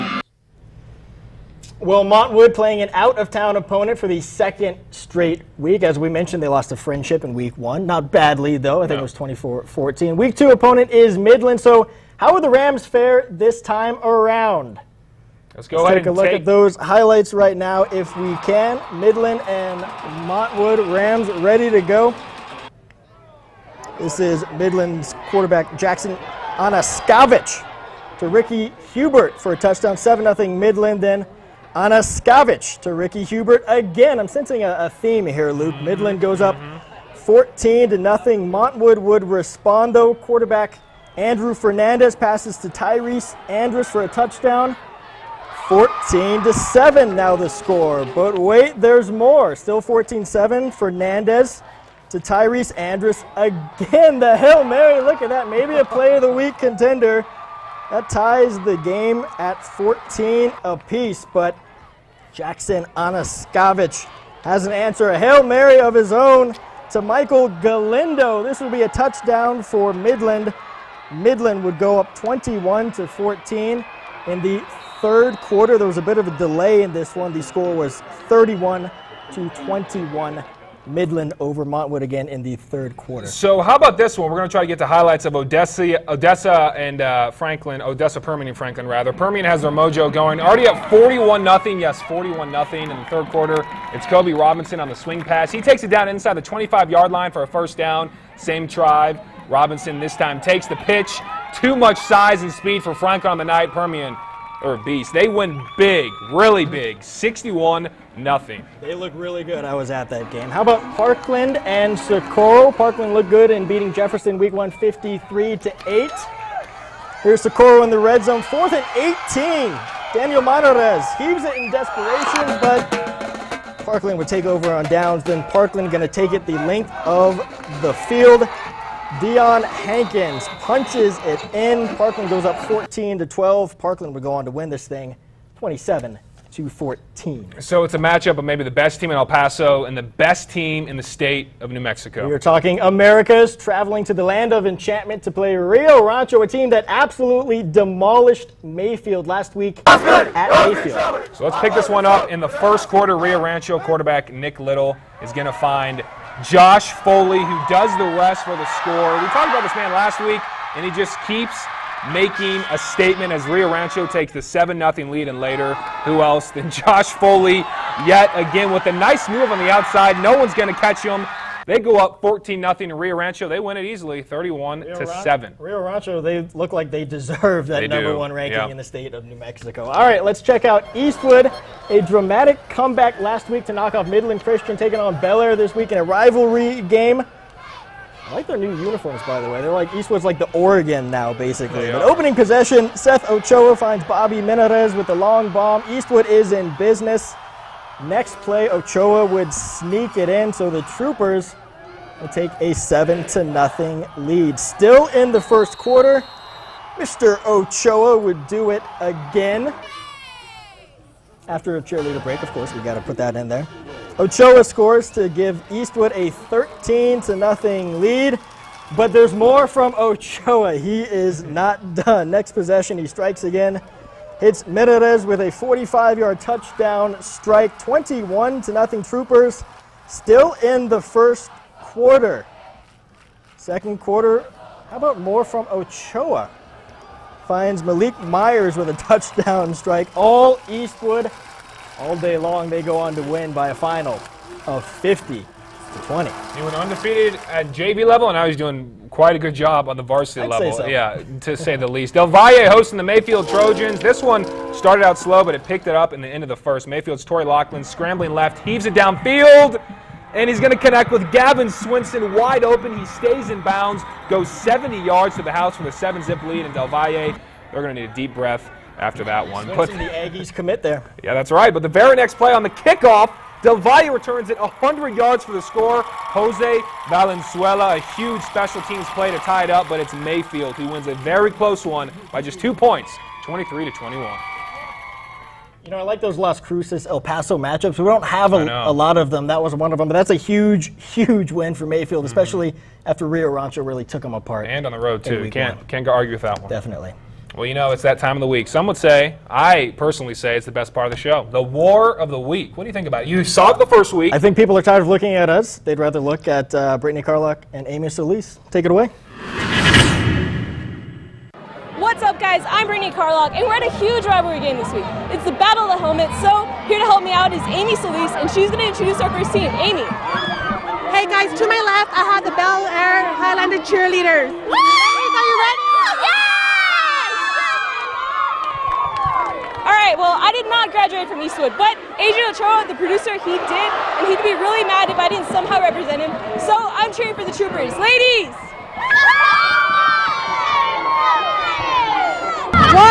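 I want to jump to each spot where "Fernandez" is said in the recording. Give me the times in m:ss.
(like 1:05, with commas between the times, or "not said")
0:41, 0:50.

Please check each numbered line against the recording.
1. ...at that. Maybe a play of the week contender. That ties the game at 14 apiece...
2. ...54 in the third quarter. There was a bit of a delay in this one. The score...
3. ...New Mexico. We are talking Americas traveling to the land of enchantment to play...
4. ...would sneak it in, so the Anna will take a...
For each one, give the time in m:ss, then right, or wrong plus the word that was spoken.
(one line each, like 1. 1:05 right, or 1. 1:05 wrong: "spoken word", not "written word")
1. 0:55 right
2. 1:13 wrong: "14", not "54"
3. 2:21 right
4. 3:19 wrong: "Troopers", not "Anna".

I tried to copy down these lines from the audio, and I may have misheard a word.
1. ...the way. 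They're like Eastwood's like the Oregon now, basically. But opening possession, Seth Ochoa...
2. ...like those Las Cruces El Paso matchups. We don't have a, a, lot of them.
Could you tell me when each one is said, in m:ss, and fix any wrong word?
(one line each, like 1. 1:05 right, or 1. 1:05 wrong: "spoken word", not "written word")
1. 3:09 right
2. 4:46 right.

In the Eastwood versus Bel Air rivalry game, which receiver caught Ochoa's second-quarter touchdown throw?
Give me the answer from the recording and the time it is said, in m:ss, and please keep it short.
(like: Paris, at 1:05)
Malik Myers, at 3:57.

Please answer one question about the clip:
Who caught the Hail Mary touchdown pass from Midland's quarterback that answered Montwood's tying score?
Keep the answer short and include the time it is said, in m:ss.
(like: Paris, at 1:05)
Michael Galindo, at 1:06.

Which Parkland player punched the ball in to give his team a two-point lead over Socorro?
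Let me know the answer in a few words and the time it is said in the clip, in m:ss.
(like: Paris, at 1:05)
Dion Hankins, at 2:09.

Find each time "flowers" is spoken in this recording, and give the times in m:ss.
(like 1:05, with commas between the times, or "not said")
not said.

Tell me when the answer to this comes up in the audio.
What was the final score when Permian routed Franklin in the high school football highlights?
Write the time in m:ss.
1:47.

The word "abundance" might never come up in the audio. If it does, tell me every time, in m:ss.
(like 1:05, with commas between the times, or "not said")
not said.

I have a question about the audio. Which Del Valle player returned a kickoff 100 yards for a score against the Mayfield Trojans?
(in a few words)
Jose Valenzuela.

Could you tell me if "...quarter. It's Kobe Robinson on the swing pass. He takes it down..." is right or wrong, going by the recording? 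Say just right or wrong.
right.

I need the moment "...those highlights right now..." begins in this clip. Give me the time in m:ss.
0:16.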